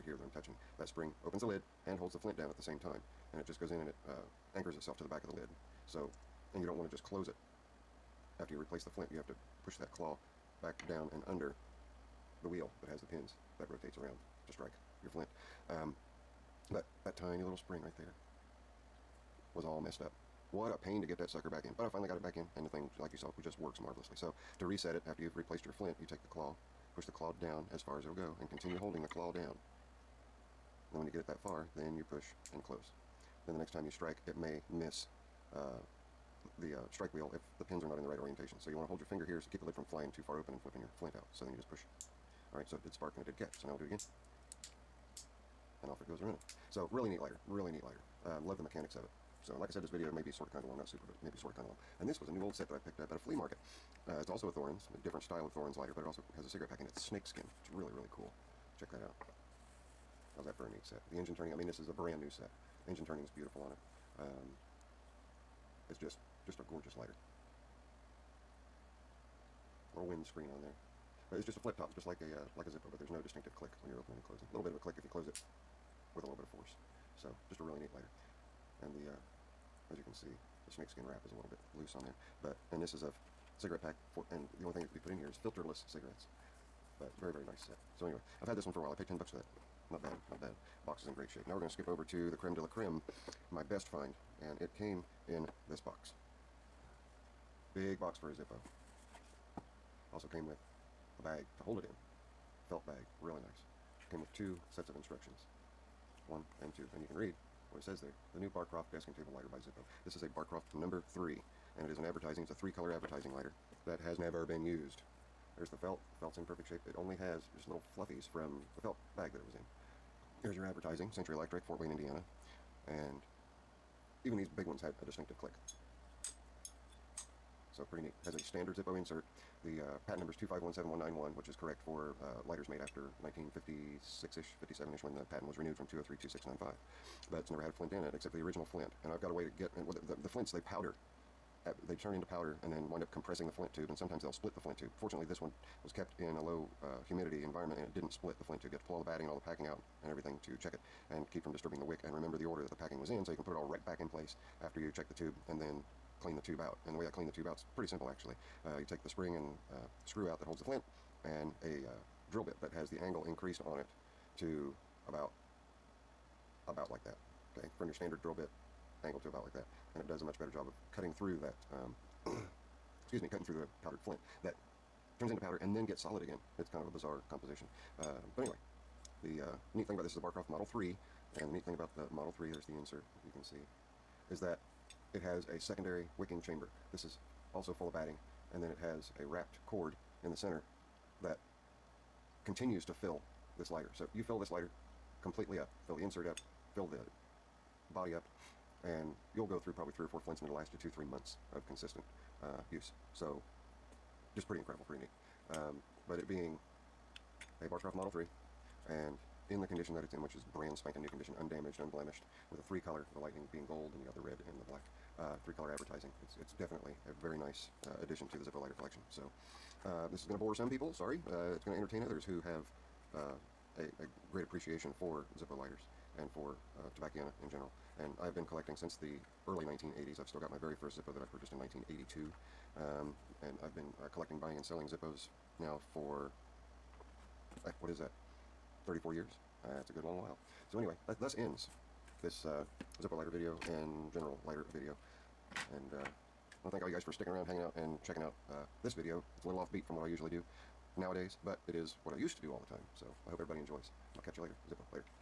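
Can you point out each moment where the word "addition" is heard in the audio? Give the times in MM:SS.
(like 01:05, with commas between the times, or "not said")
03:37.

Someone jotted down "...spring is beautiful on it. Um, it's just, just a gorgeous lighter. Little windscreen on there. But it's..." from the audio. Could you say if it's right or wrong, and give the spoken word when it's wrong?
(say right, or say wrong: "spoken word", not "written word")
wrong: "turning", not "spring".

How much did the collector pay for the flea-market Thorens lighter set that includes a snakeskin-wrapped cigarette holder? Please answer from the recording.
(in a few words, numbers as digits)
$10.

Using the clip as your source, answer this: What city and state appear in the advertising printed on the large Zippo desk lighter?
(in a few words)
Fort Wayne, Indiana.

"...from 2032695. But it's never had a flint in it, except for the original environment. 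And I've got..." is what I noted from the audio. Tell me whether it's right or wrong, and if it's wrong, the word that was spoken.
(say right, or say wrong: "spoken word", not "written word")
wrong: "flint", not "environment".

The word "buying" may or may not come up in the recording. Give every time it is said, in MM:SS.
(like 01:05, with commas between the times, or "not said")
03:54.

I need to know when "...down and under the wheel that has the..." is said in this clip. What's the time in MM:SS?
00:10.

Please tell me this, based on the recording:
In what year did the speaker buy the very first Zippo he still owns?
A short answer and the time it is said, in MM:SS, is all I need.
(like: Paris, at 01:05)
1982, at 03:51.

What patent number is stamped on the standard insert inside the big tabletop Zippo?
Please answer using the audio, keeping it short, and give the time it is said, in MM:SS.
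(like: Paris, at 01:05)
2517191, at 02:10.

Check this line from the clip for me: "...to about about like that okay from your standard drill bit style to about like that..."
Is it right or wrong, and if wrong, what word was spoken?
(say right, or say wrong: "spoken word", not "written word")
wrong: "angle", not "style".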